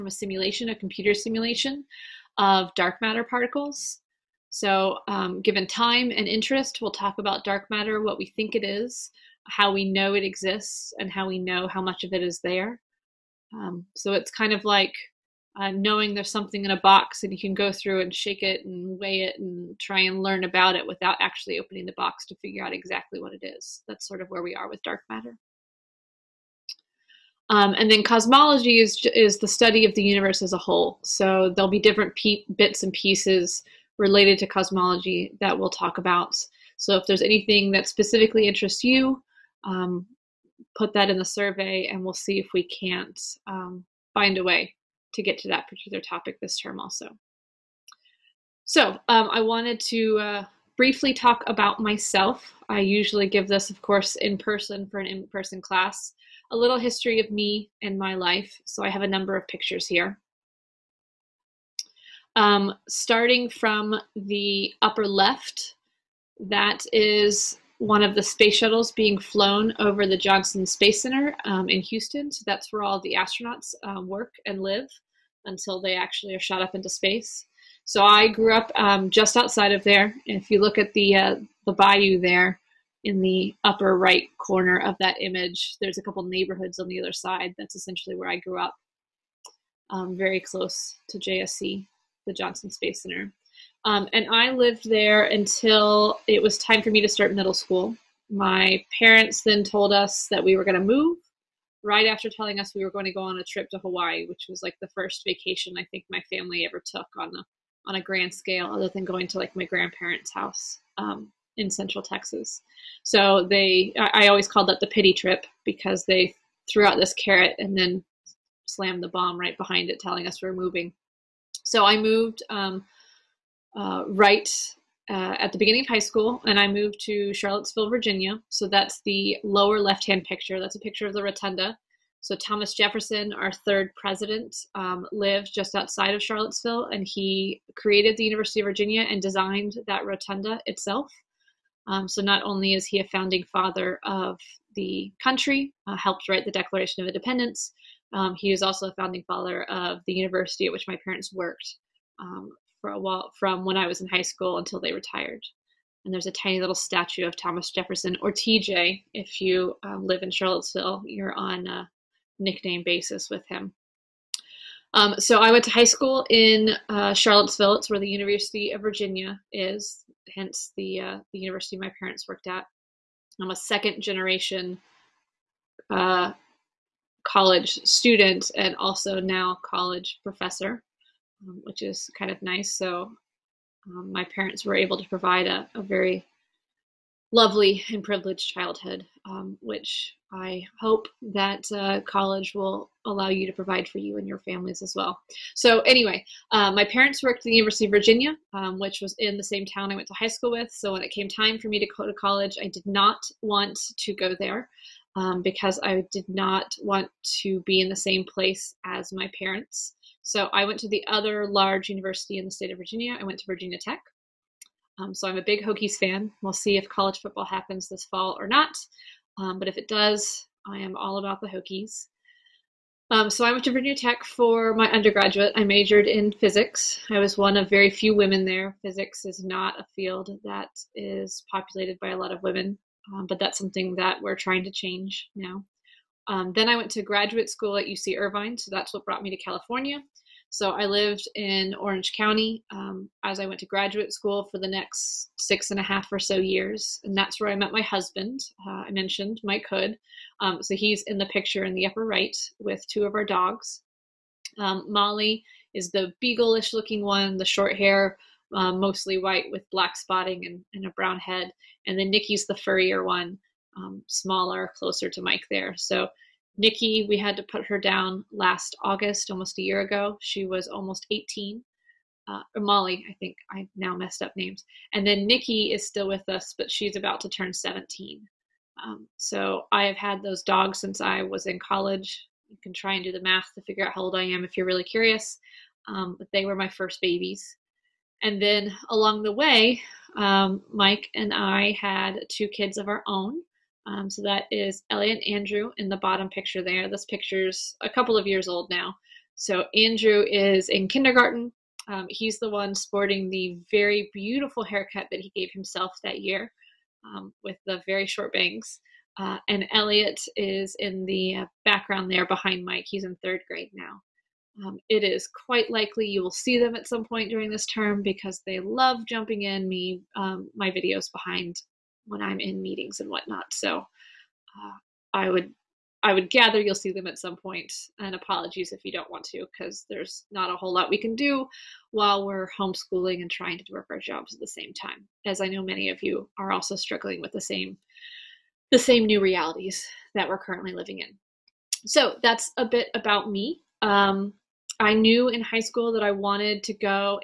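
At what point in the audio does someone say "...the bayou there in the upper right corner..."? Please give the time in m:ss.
1:21.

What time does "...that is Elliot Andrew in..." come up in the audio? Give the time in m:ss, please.
4:54.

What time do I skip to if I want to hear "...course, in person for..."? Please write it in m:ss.
0:53.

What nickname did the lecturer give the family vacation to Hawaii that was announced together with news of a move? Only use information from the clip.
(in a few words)
the pity trip.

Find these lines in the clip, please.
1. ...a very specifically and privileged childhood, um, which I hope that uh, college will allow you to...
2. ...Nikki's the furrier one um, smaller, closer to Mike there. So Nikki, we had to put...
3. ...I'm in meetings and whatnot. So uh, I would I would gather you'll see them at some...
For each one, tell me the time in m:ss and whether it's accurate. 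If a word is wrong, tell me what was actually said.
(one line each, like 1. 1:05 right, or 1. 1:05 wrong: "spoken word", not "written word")
1. 3:05 wrong: "lovely", not "specifically"
2. 4:22 right
3. 5:22 right.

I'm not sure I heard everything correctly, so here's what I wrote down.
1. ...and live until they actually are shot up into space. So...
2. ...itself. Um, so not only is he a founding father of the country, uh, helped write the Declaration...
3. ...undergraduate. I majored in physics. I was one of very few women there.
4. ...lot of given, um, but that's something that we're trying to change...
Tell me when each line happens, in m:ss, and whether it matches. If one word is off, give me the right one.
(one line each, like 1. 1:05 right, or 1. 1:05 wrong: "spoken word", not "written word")
1. 1:14 right
2. 2:20 right
3. 3:44 right
4. 3:52 wrong: "women", not "given".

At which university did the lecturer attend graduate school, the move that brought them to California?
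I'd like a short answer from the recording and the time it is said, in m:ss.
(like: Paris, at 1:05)
UC Irvine, at 3:57.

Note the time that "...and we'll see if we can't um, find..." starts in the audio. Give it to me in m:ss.
0:41.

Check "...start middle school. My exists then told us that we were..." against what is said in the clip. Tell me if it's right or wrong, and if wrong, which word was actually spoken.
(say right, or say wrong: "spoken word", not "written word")
wrong: "parents", not "exists".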